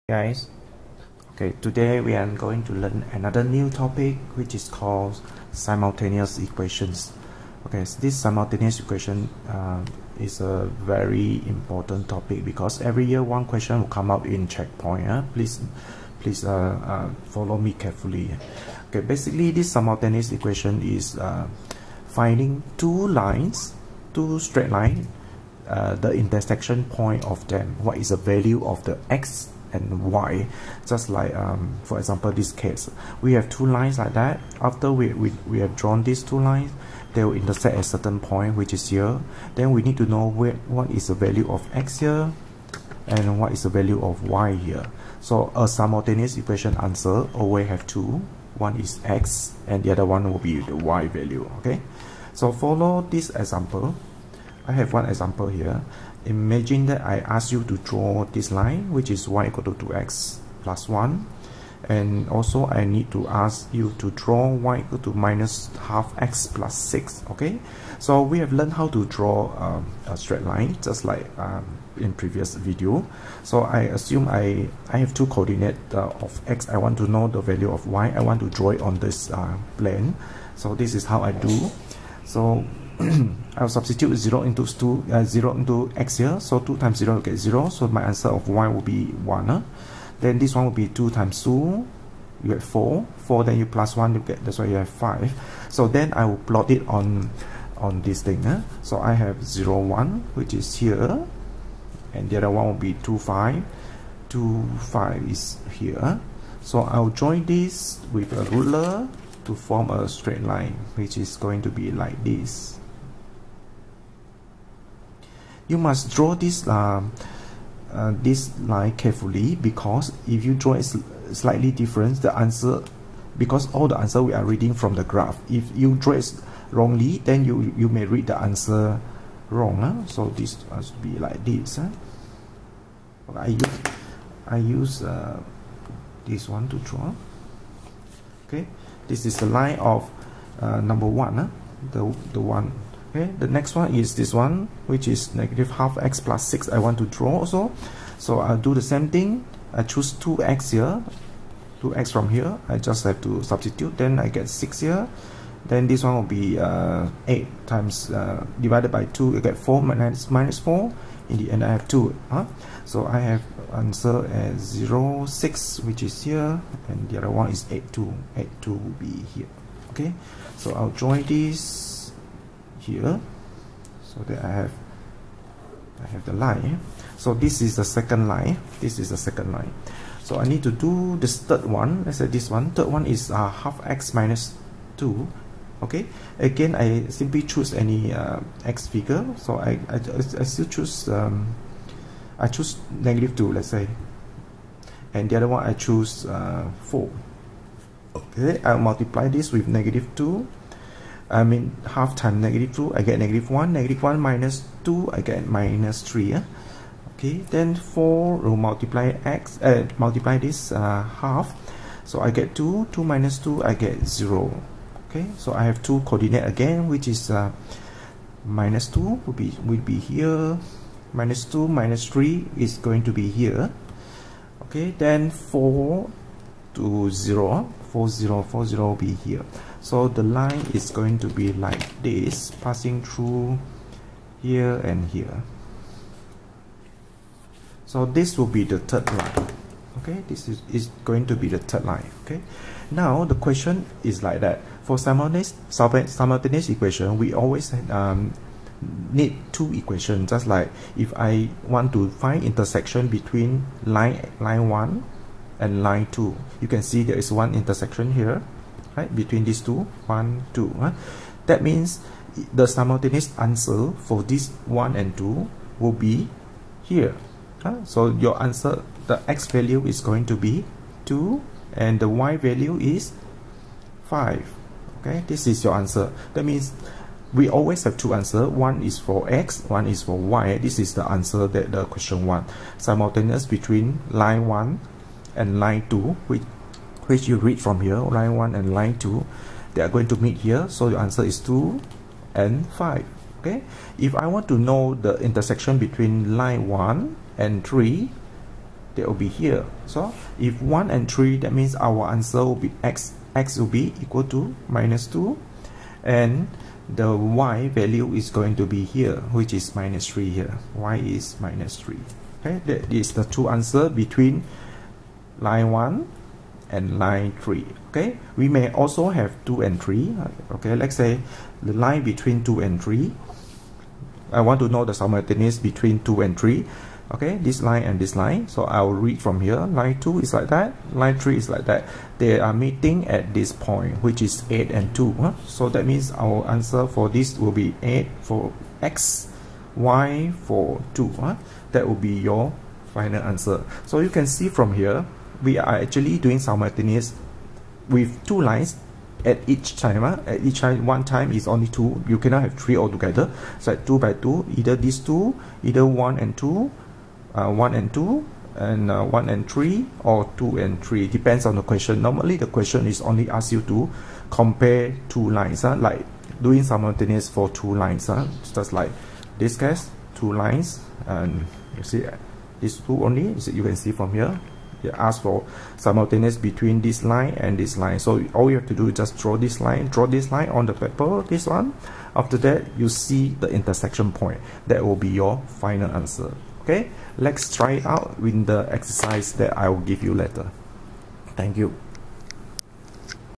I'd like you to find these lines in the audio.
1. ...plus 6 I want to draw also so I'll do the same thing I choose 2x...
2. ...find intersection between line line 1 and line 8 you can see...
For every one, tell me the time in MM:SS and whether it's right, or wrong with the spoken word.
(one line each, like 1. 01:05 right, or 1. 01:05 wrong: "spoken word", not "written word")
1. 02:26 right
2. 04:12 wrong: "2", not "8".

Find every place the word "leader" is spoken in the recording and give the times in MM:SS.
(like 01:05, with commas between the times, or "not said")
not said.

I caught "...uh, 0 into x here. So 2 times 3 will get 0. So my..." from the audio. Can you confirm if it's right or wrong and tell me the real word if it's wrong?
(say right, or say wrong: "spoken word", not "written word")
wrong: "0", not "3".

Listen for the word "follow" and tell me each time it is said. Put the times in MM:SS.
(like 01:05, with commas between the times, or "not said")
00:17, 00:52.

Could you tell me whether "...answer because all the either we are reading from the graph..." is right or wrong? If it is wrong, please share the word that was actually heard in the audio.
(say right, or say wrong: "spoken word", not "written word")
wrong: "answer", not "either".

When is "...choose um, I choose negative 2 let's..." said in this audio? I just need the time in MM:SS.
03:10.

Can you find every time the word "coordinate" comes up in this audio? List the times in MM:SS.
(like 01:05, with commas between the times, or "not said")
01:15, 03:36.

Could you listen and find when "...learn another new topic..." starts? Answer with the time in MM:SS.
00:02.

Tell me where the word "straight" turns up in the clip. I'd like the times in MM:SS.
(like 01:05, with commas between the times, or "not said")
00:24, 01:10, 01:50.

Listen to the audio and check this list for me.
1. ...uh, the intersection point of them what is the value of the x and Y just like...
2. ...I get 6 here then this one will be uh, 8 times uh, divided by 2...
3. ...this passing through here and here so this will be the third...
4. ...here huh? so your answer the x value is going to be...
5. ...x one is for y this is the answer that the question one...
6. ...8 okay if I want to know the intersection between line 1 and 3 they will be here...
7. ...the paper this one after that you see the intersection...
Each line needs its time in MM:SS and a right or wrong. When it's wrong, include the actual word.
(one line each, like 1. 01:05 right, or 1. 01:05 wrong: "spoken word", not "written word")
1. 00:25 right
2. 02:34 right
3. 03:52 right
4. 04:26 right
5. 04:39 right
6. 04:52 wrong: "5", not "8"
7. 06:20 right.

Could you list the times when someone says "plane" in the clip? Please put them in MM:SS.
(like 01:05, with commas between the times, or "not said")
01:19.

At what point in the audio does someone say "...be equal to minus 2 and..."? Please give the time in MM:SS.
05:03.